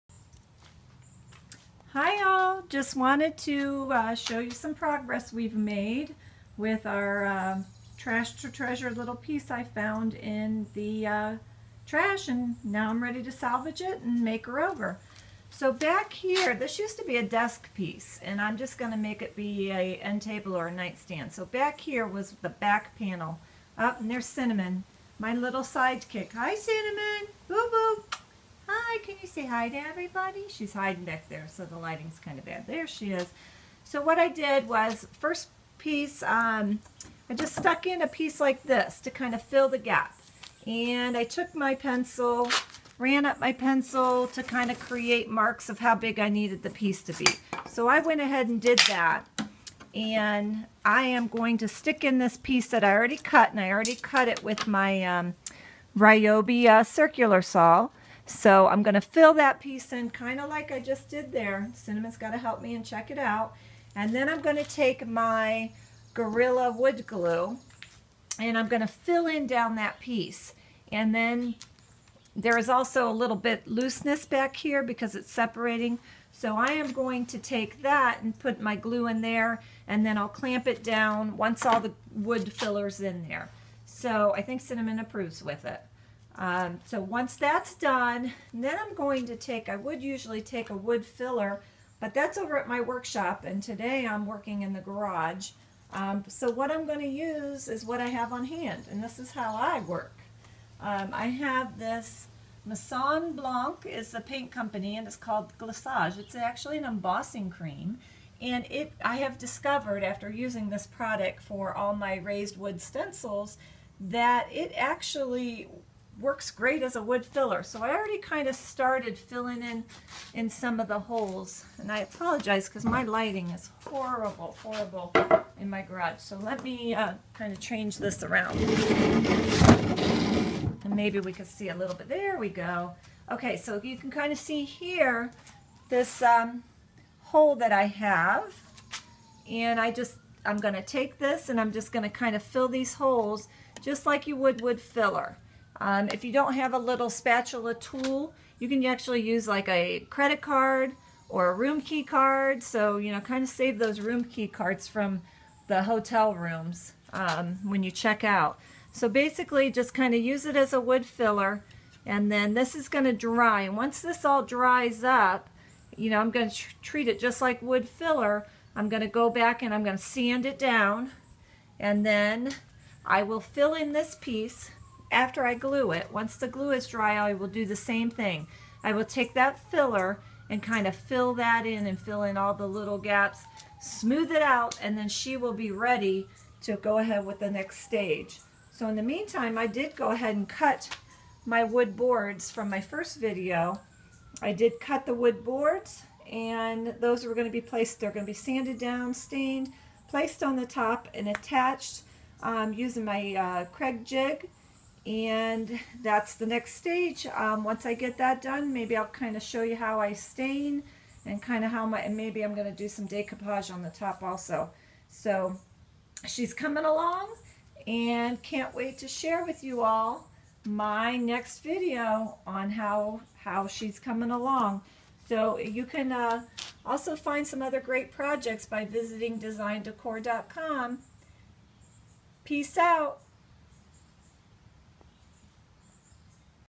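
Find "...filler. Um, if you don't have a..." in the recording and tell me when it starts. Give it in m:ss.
2:24.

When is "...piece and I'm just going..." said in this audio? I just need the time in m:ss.
0:17.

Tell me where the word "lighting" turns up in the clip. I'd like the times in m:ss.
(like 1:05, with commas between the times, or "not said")
0:31, 2:03.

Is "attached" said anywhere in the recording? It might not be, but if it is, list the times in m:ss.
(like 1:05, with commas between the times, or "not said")
3:21.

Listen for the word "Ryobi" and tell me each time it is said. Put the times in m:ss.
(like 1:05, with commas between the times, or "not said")
0:55.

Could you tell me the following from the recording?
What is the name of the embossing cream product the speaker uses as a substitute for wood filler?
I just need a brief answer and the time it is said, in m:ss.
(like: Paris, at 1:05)
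Glissage, at 1:45.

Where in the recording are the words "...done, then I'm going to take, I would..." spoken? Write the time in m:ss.
1:27.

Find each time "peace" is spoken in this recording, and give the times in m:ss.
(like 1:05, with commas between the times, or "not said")
3:52.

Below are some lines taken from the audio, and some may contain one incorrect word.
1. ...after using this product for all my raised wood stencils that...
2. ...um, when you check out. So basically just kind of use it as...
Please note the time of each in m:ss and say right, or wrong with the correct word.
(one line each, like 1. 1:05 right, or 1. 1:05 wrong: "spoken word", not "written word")
1. 1:50 right
2. 2:37 right.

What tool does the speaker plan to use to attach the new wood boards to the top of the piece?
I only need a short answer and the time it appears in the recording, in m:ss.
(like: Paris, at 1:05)
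Kreg jig, at 3:23.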